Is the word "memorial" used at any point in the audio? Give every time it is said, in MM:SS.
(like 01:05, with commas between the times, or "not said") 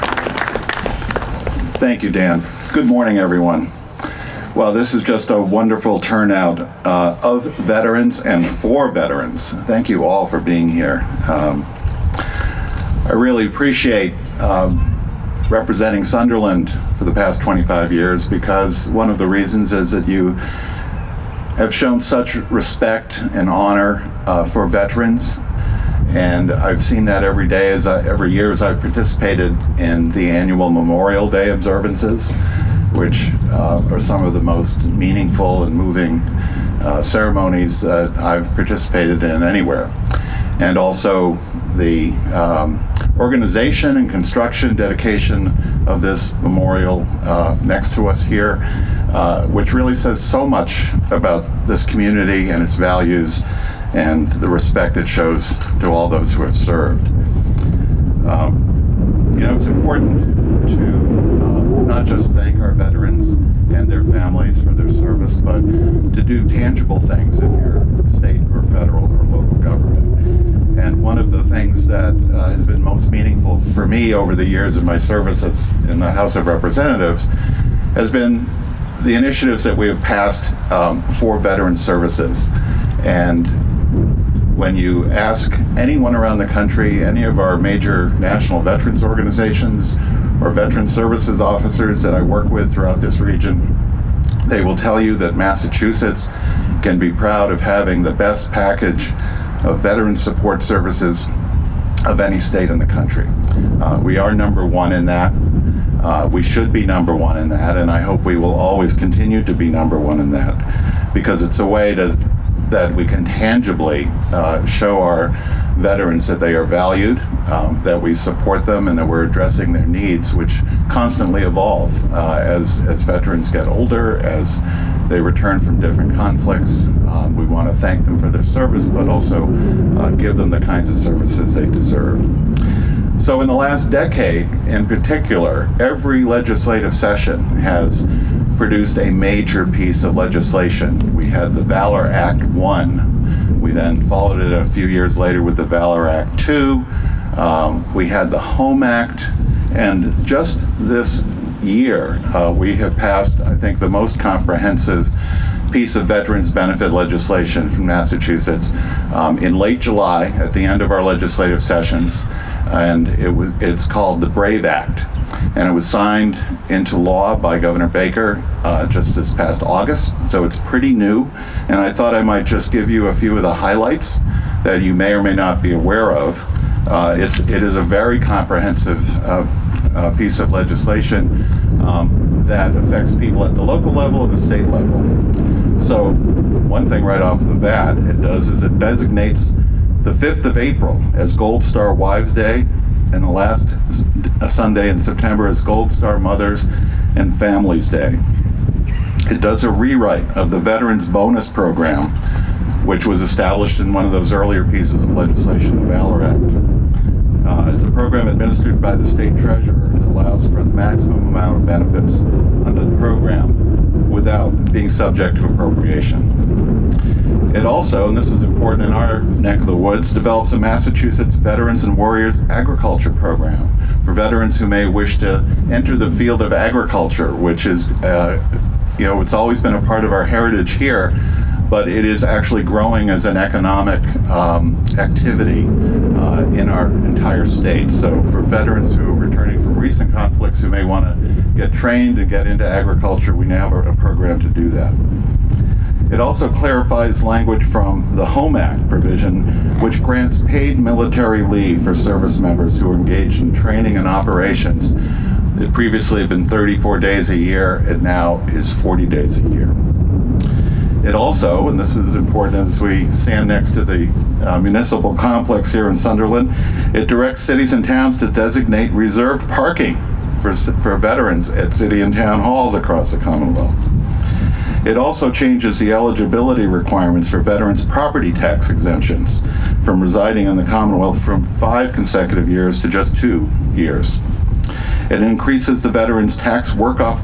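00:30, 00:46.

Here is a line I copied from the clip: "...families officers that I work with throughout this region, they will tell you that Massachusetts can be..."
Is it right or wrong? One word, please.
wrong.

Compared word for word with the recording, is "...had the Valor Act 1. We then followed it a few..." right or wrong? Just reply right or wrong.
right.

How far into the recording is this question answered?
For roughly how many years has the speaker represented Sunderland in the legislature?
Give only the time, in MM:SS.
00:17.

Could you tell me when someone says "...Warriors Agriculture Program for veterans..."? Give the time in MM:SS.
03:41.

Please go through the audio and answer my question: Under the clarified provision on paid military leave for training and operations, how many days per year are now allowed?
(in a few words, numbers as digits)
40 days.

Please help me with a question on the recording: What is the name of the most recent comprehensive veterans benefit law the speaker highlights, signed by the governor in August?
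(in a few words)
Brave Act.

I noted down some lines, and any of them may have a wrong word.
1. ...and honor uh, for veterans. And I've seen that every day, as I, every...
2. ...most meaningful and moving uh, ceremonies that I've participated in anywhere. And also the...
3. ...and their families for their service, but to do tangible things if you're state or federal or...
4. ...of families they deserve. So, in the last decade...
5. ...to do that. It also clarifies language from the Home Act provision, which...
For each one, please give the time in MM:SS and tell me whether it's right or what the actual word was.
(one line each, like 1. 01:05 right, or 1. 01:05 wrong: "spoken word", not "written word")
1. 00:23 right
2. 00:34 right
3. 01:03 right
4. 02:10 wrong: "services", not "families"
5. 04:04 right.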